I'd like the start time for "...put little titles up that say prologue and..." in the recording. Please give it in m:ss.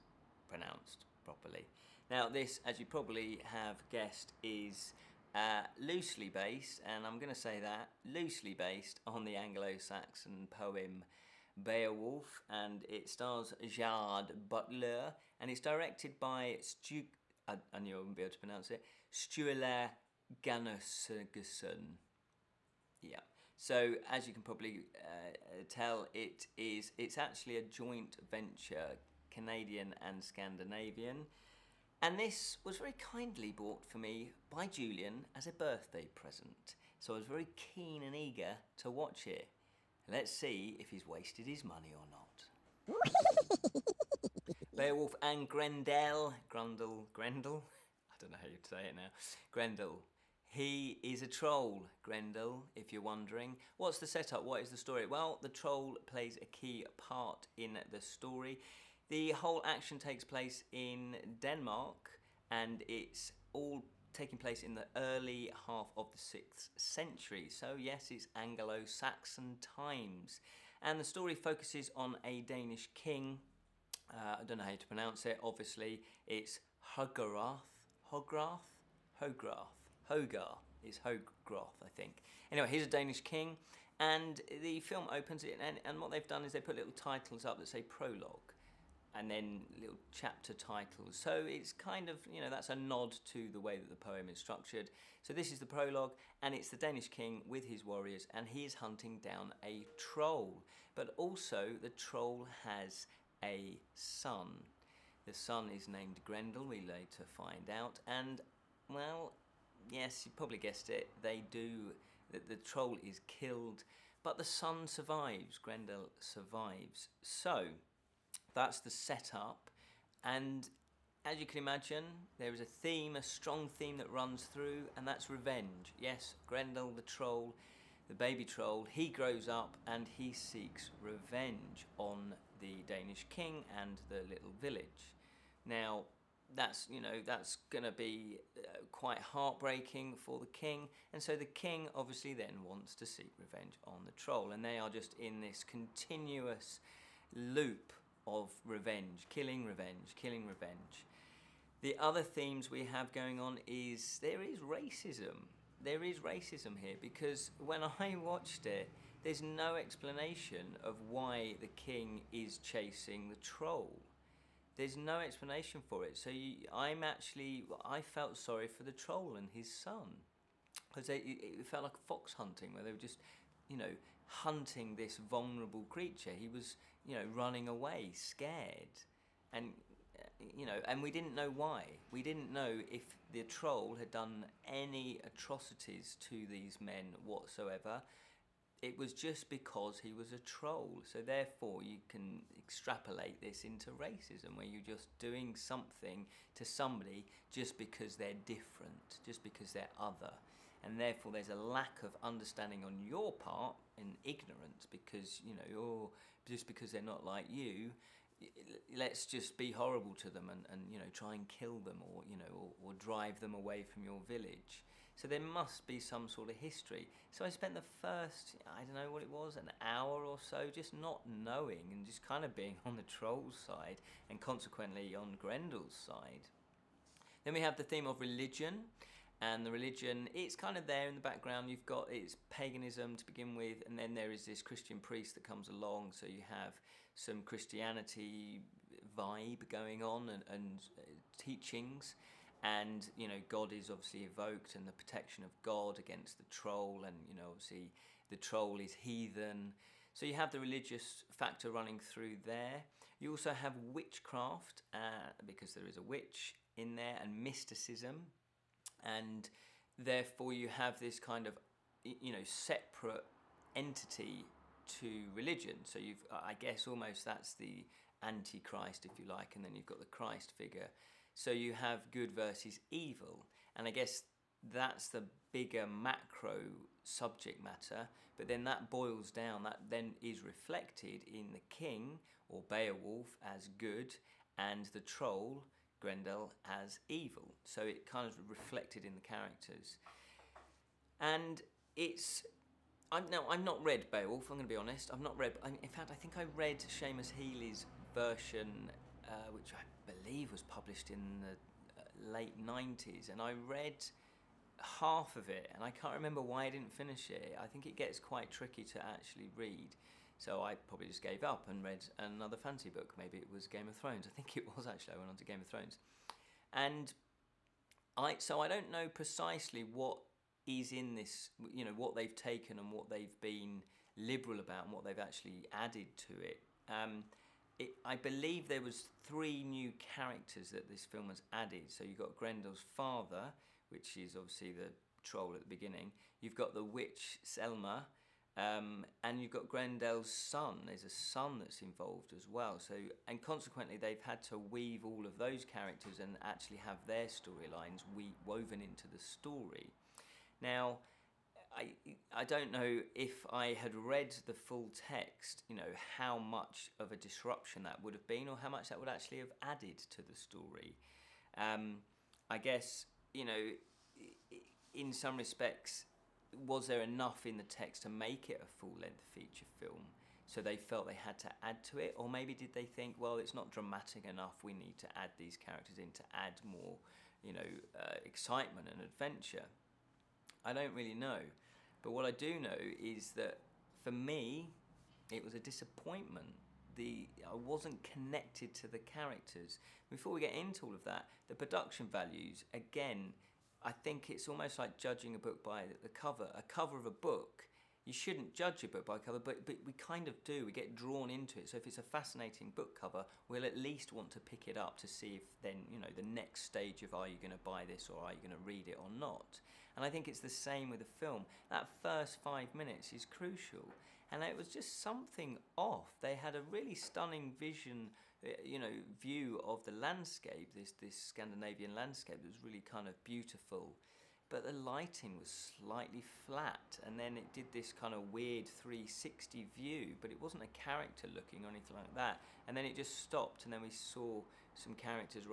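1:26.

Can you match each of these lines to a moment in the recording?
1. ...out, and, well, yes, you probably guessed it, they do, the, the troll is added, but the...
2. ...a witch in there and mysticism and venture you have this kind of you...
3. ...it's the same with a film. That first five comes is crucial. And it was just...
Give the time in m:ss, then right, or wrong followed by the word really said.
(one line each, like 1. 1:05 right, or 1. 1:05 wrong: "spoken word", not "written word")
1. 1:47 wrong: "killed", not "added"
2. 4:15 wrong: "therefore", not "venture"
3. 6:50 wrong: "minutes", not "comes".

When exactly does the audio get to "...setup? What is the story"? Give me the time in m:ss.
0:54.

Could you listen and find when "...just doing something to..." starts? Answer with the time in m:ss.
3:14.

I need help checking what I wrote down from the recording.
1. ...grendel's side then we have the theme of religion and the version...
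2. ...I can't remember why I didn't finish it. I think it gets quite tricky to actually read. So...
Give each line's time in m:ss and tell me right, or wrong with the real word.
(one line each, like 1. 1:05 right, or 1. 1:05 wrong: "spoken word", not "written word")
1. 3:45 wrong: "religion", not "version"
2. 5:05 right.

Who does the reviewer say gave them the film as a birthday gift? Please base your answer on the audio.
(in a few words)
Julian.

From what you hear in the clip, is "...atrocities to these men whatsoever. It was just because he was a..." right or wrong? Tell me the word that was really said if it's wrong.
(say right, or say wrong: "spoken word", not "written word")
right.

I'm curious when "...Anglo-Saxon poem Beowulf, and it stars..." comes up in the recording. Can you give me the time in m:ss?
0:09.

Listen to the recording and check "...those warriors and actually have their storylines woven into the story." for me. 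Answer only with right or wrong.
wrong.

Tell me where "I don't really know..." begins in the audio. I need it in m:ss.
6:20.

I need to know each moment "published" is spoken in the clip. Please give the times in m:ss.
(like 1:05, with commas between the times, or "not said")
5:00.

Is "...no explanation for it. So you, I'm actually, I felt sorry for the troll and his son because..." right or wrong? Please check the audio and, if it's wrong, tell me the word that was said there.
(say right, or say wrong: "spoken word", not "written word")
right.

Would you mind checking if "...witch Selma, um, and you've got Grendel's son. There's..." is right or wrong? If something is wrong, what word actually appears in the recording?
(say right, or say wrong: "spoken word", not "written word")
right.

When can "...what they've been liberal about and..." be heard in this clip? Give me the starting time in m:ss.
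5:22.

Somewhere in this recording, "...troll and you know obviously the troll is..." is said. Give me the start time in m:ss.
4:06.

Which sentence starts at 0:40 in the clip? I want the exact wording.
Let's see if he's wasted his money or not.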